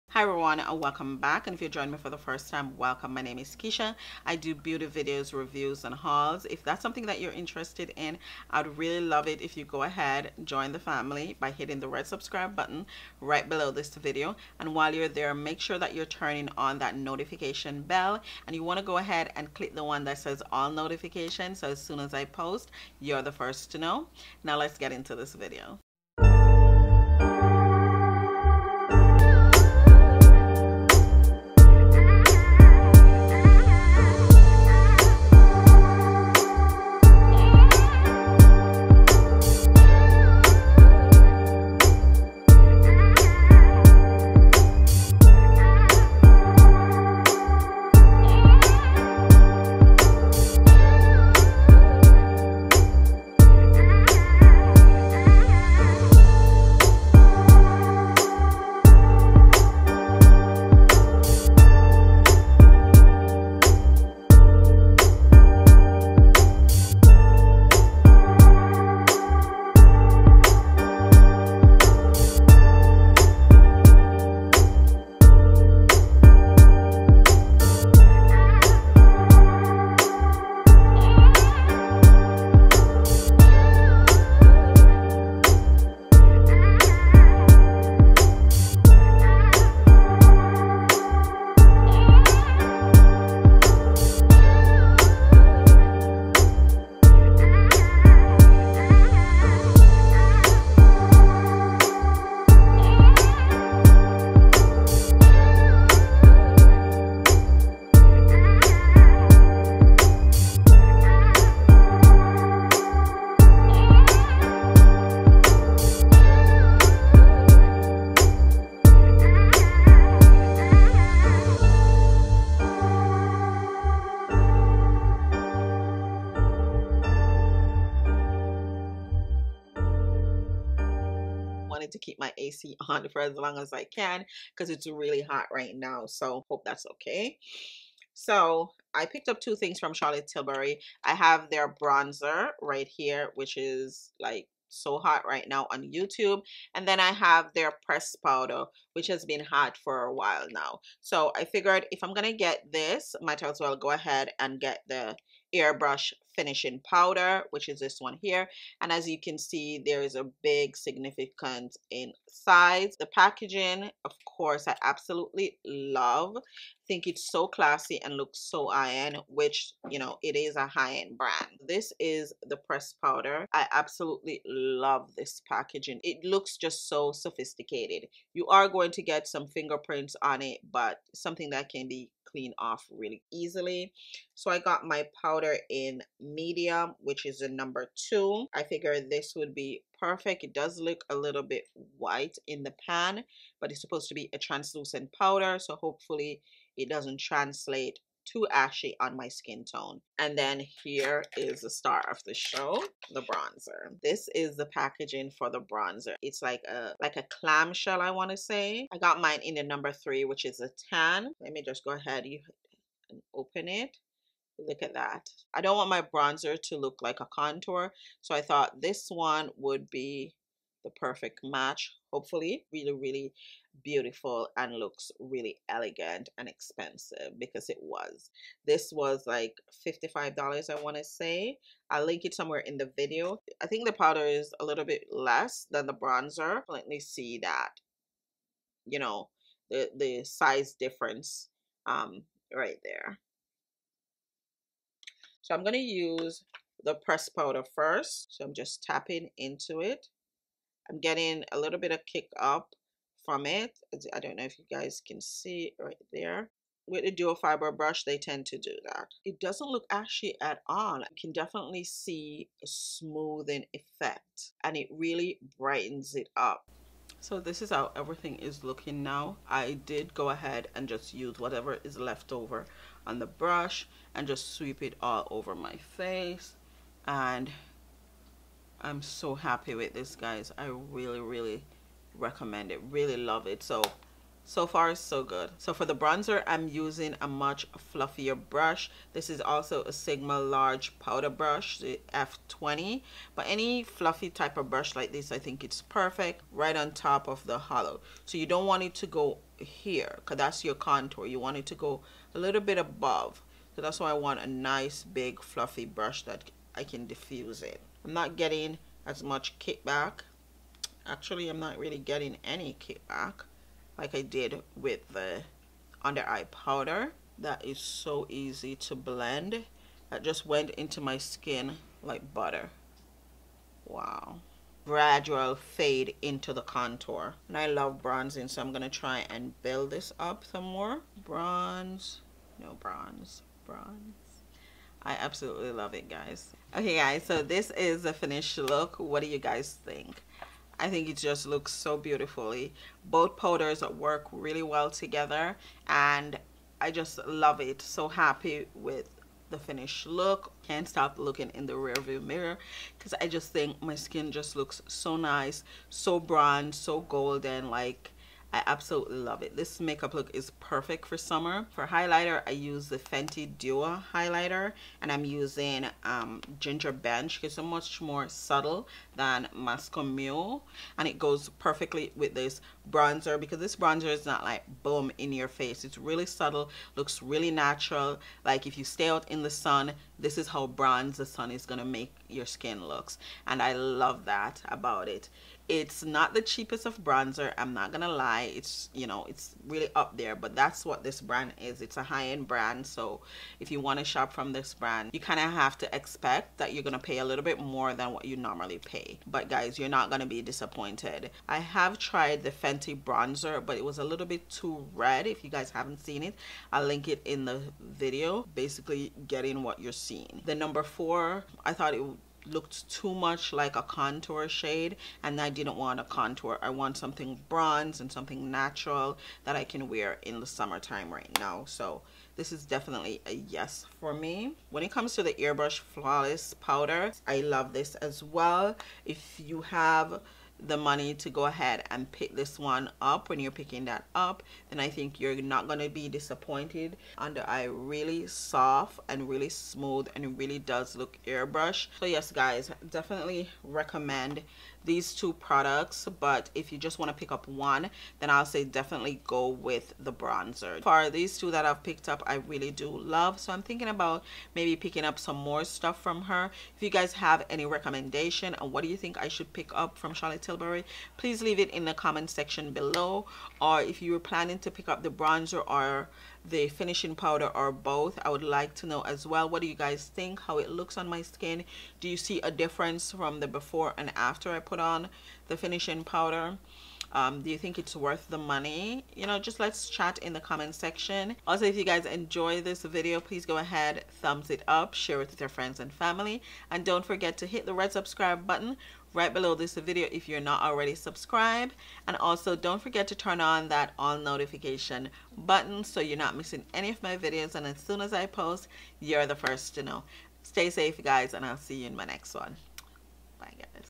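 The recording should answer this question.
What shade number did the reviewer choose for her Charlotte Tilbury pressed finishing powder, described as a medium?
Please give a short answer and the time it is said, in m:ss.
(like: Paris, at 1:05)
2, at 3:07.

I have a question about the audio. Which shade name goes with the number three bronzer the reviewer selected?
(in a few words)
tan.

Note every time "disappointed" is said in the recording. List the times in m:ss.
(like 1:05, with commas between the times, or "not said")
6:40, 7:16.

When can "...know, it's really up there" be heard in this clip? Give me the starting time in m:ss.
6:29.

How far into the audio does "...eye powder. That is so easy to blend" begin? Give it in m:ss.
5:16.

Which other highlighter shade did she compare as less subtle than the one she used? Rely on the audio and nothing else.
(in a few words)
Moscow Mule.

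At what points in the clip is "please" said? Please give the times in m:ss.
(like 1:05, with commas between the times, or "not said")
7:41, 8:03.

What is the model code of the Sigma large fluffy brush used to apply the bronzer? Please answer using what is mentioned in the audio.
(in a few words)
F20.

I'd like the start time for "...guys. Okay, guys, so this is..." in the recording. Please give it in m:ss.
5:36.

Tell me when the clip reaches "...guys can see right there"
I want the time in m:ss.
4:14.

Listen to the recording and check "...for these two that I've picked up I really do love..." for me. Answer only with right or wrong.
right.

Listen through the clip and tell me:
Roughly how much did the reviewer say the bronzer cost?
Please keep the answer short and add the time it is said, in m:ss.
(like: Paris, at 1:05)
$55, at 3:49.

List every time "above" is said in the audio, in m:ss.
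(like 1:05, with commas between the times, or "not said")
5:02.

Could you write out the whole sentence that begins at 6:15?
It's really subtle, looks really natural.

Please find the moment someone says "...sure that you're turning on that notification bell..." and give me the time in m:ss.
0:15.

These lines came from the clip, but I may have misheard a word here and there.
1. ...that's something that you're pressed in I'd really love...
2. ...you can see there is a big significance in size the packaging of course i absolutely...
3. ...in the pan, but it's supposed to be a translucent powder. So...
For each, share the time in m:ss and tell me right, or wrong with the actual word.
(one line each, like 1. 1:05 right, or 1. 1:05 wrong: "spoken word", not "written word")
1. 0:06 wrong: "interested", not "pressed"
2. 2:39 right
3. 3:12 right.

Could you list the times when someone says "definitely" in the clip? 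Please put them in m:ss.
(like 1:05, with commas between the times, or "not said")
4:21, 7:02, 7:22, 7:28.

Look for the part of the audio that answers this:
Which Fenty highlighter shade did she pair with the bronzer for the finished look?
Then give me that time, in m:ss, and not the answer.
6:06.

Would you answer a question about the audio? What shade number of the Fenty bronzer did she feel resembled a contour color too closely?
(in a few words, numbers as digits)
4.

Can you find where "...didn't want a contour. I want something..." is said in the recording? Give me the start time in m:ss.
6:55.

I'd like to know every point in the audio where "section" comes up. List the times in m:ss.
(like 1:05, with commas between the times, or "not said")
7:42, 8:00.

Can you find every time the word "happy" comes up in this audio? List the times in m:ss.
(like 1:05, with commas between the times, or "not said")
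4:39, 5:48.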